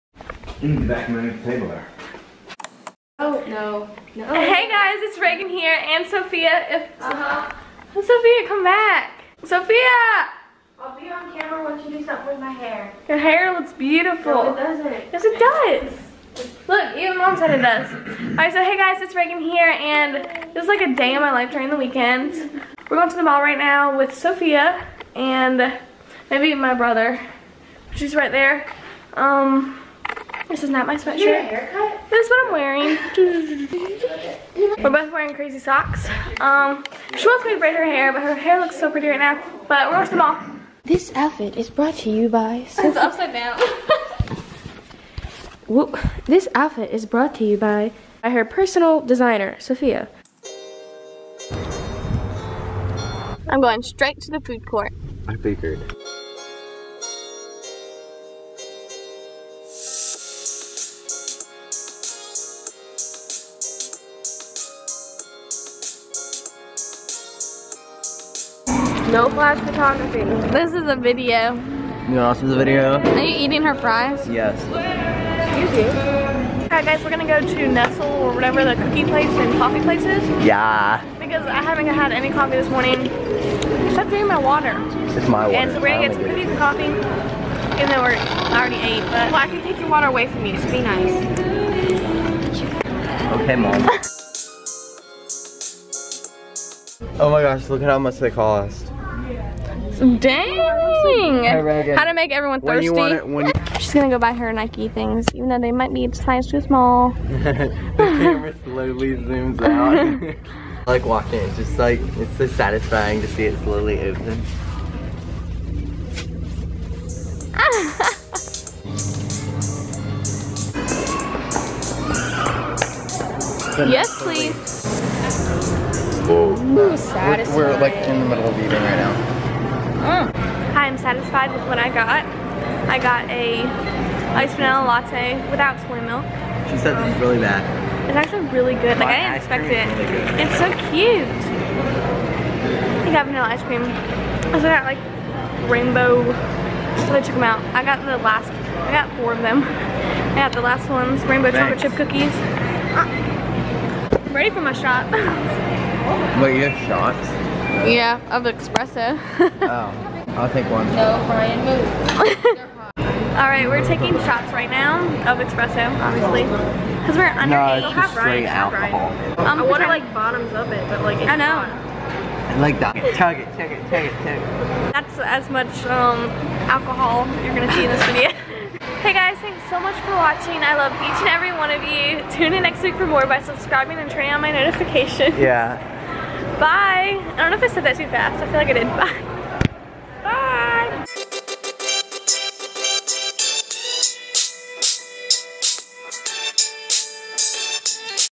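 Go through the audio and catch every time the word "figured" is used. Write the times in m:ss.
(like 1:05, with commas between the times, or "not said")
0:55.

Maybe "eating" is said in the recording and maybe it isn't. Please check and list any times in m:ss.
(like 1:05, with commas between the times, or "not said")
1:13, 2:08.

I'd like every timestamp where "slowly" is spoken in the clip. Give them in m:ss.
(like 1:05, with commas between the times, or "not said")
1:48, 1:53.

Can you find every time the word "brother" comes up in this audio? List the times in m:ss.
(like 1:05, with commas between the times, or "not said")
0:26.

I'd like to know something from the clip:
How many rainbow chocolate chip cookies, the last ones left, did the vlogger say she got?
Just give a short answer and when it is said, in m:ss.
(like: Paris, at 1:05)
4, at 2:29.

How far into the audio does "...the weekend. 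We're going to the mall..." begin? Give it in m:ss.
0:21.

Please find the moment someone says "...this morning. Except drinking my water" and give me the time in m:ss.
1:22.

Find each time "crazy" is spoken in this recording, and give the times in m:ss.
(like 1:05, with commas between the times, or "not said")
0:35.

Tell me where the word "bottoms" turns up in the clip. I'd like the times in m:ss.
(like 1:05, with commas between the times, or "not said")
2:50.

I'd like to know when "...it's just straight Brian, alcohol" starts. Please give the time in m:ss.
2:47.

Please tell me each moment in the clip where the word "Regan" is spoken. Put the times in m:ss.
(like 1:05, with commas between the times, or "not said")
0:05, 0:19.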